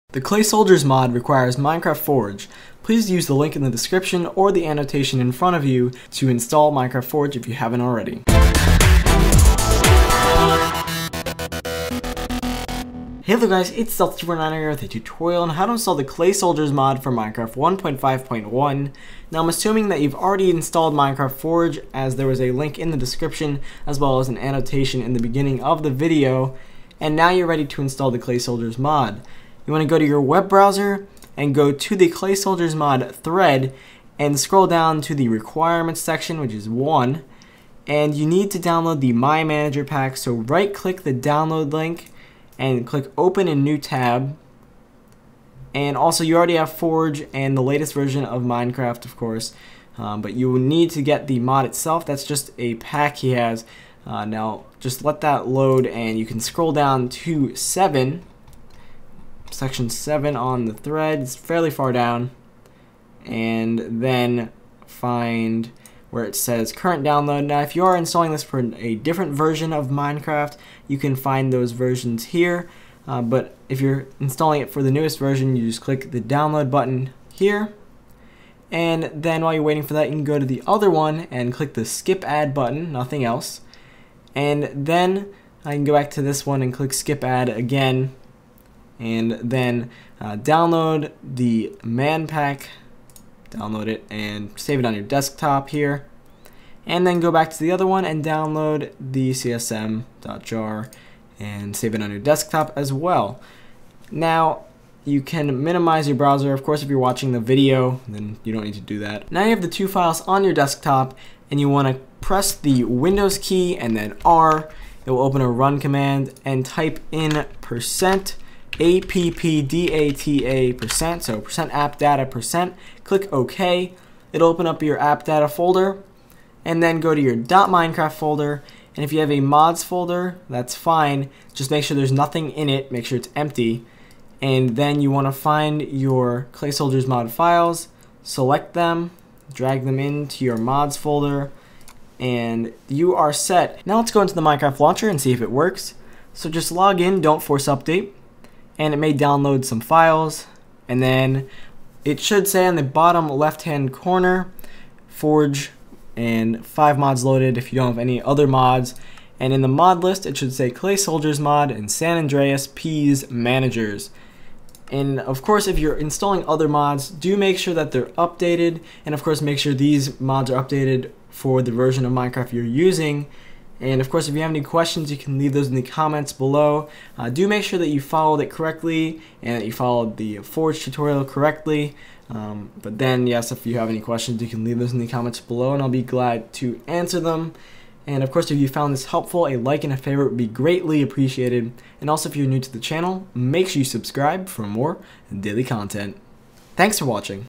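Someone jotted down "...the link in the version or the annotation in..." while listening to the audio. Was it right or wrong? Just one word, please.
wrong.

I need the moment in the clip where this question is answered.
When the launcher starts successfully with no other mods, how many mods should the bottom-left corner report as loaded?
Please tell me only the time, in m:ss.
2:36.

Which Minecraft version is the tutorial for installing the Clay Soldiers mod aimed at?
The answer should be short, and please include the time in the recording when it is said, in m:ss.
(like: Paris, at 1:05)
1.5.1, at 0:17.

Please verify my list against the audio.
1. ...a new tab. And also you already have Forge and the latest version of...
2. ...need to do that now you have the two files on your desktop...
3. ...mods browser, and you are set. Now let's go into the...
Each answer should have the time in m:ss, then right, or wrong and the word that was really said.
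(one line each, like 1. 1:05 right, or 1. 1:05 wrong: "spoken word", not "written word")
1. 0:43 right
2. 1:48 right
3. 2:20 wrong: "folder", not "browser".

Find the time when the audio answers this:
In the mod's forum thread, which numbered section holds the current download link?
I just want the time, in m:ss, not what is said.
0:59.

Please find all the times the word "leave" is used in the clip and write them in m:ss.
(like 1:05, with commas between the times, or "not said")
2:55, 3:04.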